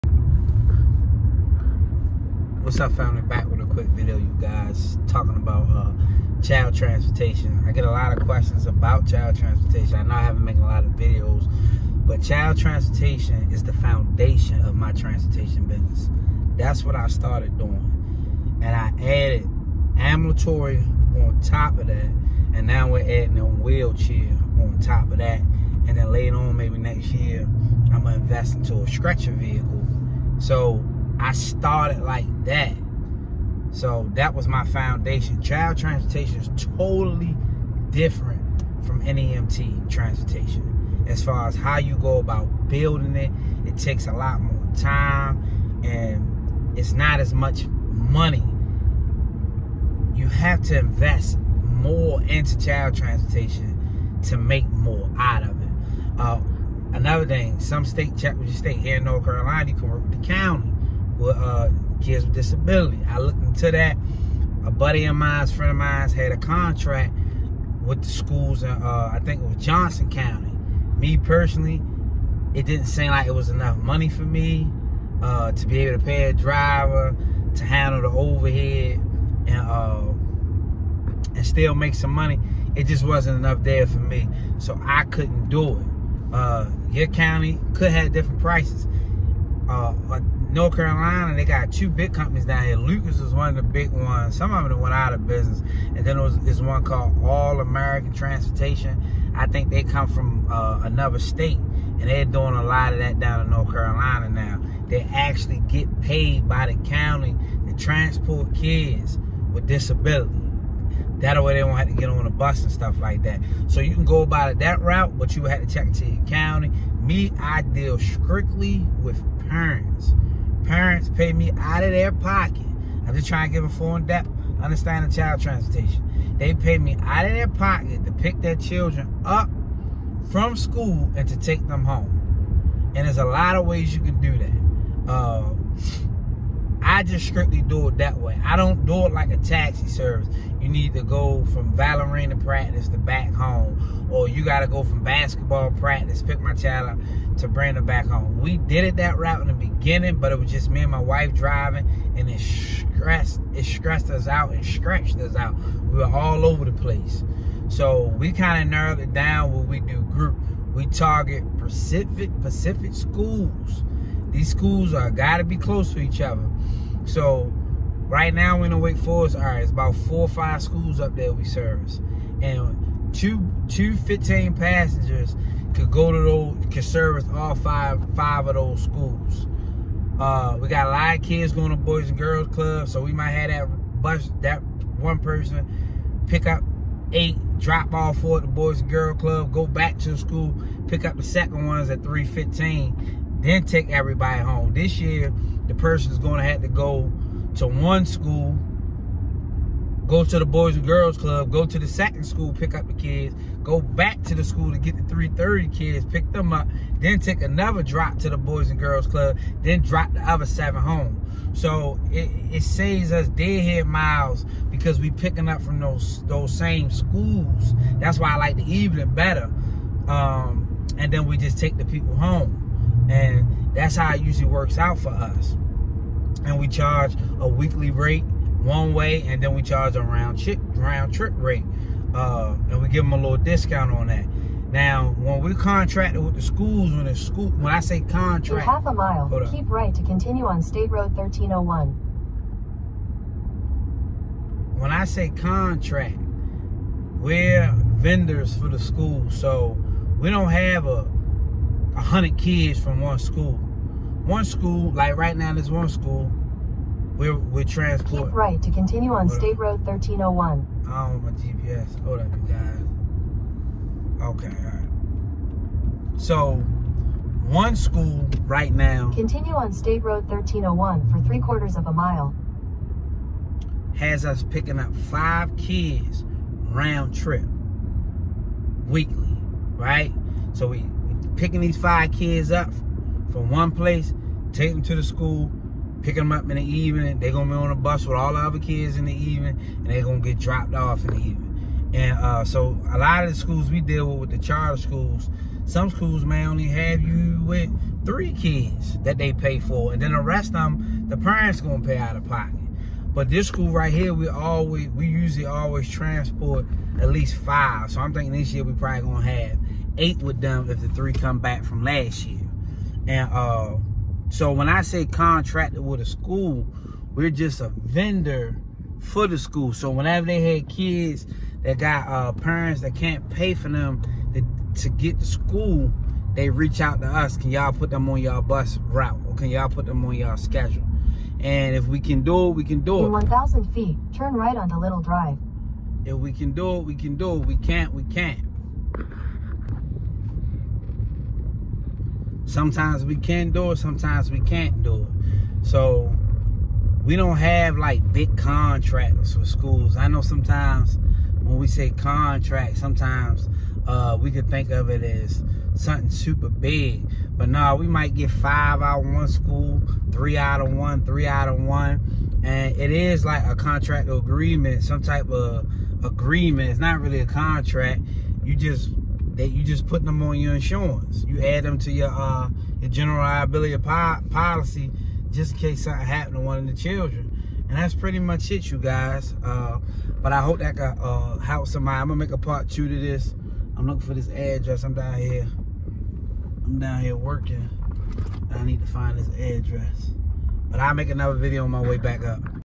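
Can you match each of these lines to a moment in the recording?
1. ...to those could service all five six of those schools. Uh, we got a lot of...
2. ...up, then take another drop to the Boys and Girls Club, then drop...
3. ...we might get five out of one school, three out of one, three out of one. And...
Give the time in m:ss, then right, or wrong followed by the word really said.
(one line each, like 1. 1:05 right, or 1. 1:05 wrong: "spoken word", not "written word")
1. 2:56 wrong: "five", not "six"
2. 3:26 right
3. 5:57 right.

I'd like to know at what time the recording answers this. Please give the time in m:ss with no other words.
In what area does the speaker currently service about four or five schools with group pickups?
2:48.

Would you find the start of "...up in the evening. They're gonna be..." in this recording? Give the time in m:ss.
4:46.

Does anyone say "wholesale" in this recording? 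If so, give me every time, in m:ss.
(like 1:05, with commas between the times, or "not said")
not said.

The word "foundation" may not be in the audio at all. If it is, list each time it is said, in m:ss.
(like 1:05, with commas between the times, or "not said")
0:13, 0:34.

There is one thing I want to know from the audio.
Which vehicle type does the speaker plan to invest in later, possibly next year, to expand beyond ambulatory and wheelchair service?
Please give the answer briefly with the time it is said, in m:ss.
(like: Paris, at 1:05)
stretcher vehicle, at 0:28.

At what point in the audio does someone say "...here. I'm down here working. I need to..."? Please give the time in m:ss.
6:25.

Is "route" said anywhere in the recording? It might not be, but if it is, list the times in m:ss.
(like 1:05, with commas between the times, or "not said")
1:54, 2:29, 5:28.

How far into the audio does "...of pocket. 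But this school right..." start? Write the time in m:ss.
5:02.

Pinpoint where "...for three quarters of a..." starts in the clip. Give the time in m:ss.
4:31.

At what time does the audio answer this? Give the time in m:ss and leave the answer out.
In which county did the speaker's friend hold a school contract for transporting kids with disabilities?
1:09.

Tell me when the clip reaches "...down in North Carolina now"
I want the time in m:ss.
1:43.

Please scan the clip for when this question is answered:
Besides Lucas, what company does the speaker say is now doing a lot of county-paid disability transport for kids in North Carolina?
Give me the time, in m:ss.
1:37.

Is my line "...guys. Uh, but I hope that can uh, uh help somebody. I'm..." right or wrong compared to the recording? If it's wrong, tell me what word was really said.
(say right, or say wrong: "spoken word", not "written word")
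right.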